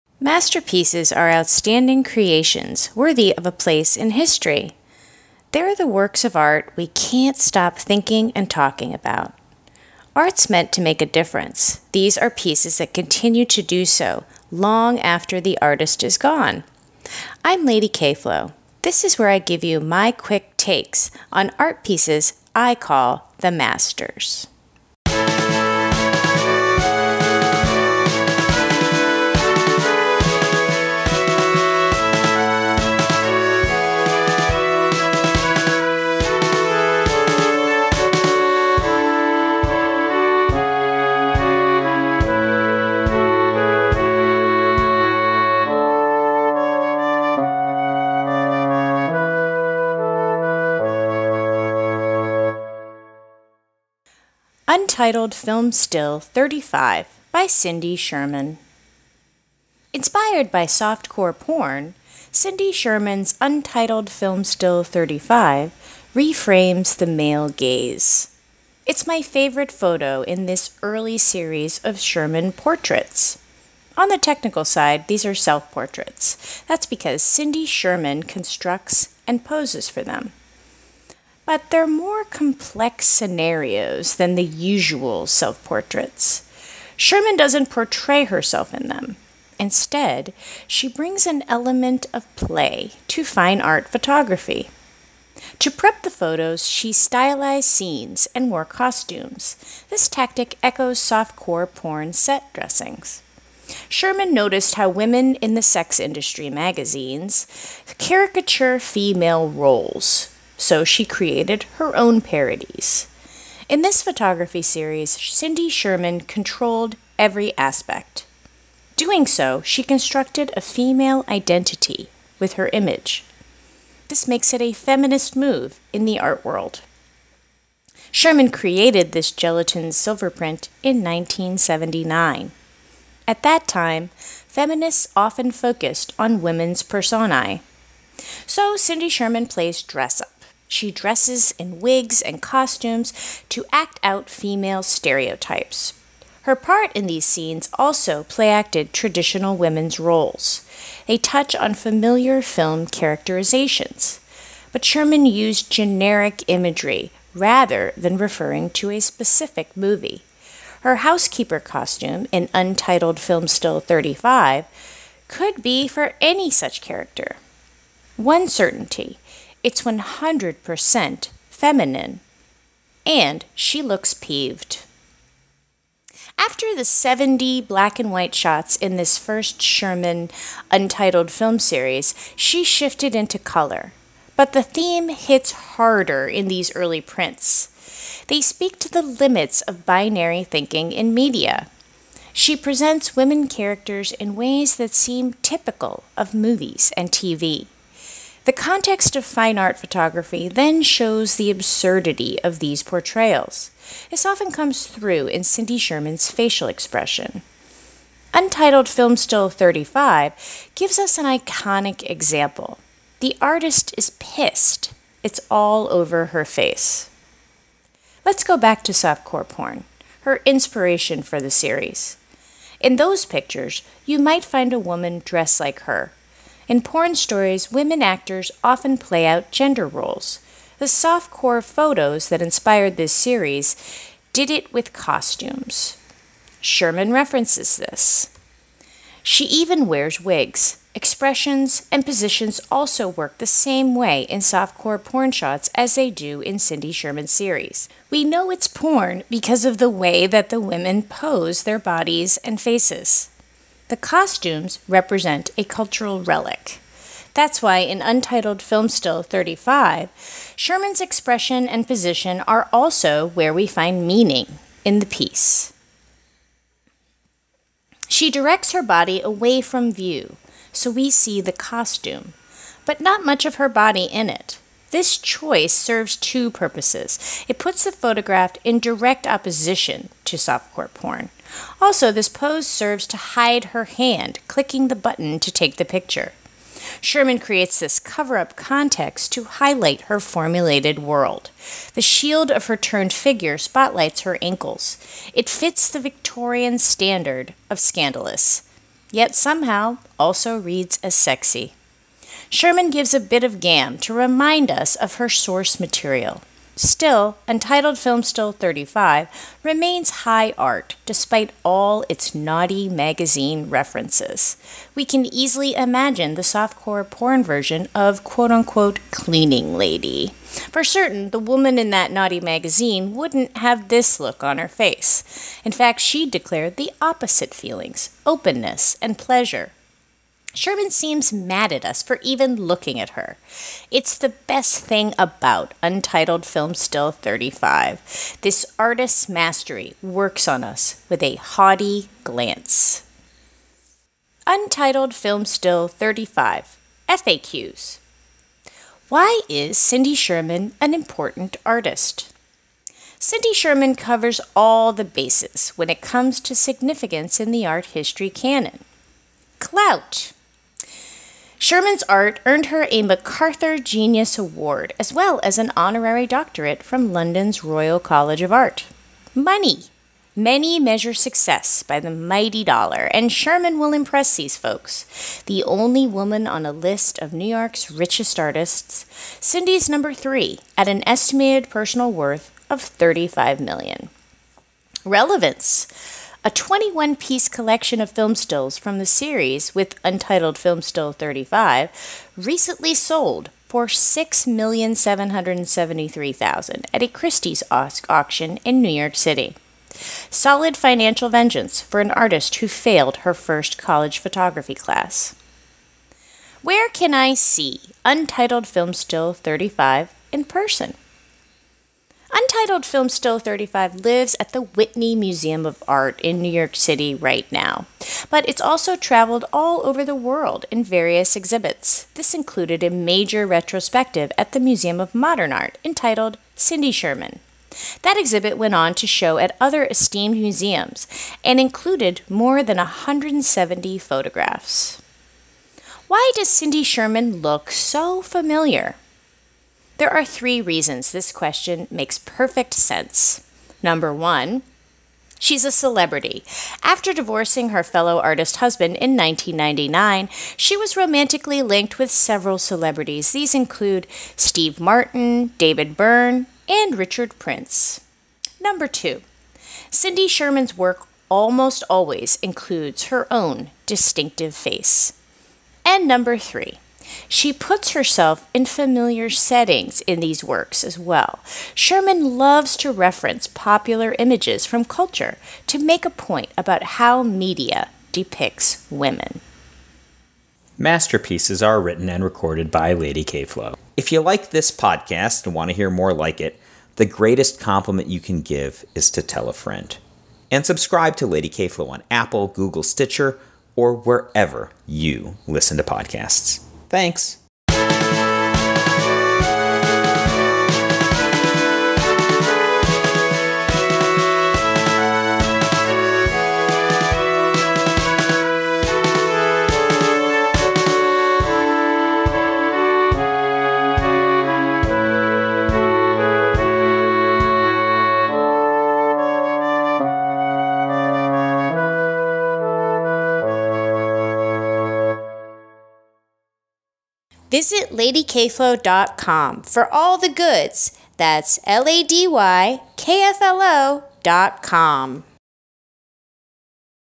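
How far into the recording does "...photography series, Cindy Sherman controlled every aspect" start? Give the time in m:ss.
1:54.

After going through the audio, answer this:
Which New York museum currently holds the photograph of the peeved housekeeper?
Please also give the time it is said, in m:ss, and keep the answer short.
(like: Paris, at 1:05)
Whitney Museum of Art, at 6:54.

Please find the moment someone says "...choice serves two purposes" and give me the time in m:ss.
4:35.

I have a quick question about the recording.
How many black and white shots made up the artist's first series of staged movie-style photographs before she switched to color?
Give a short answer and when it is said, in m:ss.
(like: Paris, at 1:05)
70, at 2:56.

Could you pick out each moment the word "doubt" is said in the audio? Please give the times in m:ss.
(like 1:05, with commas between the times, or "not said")
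not said.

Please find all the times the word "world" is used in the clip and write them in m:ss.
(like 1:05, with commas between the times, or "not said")
2:06, 4:50, 7:00.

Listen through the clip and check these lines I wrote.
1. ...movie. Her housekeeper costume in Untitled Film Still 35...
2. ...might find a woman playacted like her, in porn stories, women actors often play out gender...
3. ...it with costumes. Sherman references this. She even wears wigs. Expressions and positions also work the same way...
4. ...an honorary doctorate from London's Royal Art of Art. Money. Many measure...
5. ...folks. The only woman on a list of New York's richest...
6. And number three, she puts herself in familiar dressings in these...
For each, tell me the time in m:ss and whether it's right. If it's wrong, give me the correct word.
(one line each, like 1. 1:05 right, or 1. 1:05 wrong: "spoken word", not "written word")
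1. 2:39 right
2. 3:44 wrong: "dressed", not "playacted"
3. 3:54 right
4. 6:05 wrong: "College", not "Art"
5. 6:14 right
6. 7:45 wrong: "settings", not "dressings".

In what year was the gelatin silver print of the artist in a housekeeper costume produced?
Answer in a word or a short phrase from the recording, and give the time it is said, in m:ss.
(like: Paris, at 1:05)
1979, at 2:10.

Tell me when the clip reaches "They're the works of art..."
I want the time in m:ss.
0:05.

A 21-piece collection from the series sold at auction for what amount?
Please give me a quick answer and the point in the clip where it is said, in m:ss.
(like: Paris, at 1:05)
6,773,000, at 6:33.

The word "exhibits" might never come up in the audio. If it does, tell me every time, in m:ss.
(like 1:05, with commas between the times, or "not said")
7:01, 7:08.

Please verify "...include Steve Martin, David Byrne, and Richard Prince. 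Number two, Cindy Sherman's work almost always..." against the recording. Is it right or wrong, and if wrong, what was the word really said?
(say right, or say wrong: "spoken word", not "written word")
right.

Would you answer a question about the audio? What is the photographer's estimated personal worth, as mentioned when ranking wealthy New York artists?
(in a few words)
35 million.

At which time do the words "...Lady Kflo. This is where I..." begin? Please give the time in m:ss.
0:17.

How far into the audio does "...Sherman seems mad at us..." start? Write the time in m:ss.
5:30.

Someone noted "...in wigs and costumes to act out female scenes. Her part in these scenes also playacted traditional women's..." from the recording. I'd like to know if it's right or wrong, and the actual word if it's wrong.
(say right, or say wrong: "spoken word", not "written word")
wrong: "stereotypes", not "scenes".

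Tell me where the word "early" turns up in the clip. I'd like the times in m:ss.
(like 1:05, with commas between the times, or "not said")
1:10, 3:06.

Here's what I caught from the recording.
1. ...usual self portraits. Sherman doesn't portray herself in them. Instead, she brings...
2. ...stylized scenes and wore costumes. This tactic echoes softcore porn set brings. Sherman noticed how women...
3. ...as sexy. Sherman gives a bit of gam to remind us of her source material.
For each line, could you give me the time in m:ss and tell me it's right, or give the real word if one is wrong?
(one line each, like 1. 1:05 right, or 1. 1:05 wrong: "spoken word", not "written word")
1. 1:24 right
2. 1:36 wrong: "dressings", not "brings"
3. 5:01 right.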